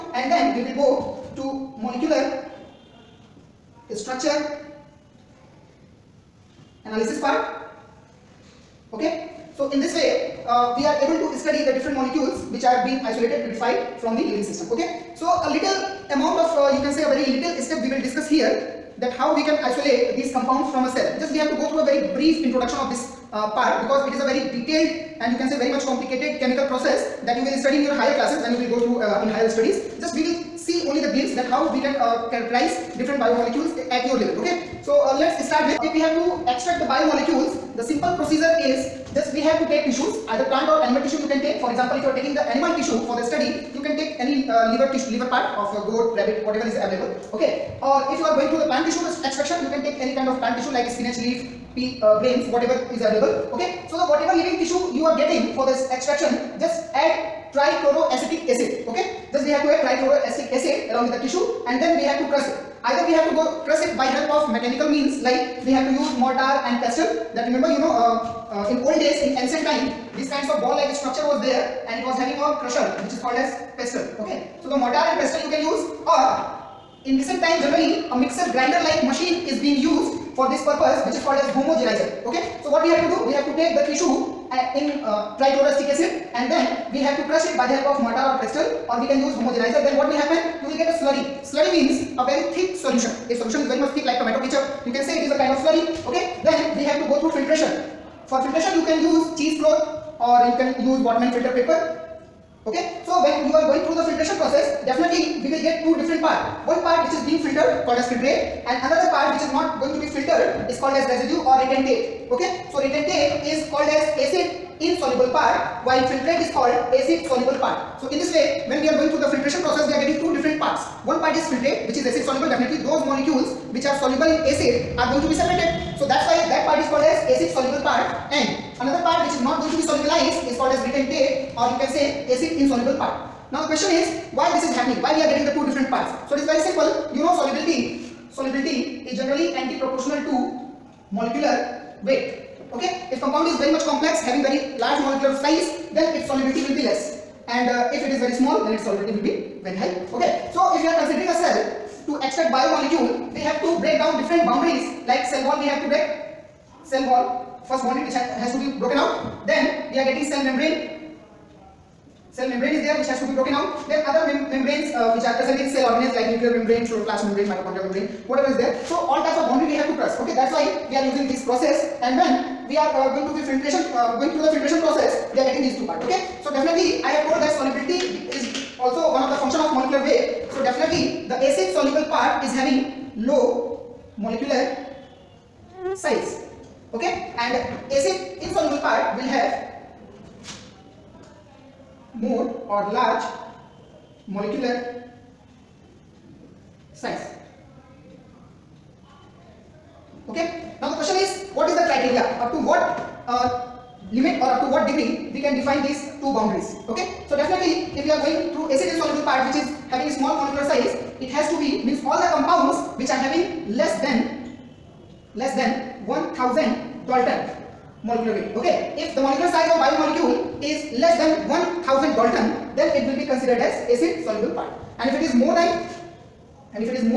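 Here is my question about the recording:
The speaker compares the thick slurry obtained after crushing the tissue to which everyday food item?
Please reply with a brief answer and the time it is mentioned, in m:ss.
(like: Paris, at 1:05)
Tomato ketchup, at 1:34.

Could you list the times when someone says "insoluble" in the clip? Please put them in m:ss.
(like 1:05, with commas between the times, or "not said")
1:54, 2:12, 3:08, 3:28.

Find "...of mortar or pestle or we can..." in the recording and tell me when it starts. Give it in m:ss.
1:27.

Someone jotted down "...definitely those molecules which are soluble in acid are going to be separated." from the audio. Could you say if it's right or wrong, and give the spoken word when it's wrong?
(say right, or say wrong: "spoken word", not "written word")
right.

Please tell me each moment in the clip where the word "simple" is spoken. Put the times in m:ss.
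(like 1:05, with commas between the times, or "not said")
0:37, 2:16.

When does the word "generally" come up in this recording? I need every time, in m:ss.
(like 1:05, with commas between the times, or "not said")
1:17, 2:19.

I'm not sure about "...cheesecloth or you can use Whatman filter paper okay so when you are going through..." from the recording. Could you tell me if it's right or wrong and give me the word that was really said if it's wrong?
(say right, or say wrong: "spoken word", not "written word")
right.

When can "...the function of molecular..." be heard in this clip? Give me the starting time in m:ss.
2:59.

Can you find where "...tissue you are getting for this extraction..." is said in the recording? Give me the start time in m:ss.
0:54.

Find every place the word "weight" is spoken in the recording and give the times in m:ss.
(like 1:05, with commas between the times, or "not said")
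2:22, 3:00, 3:38.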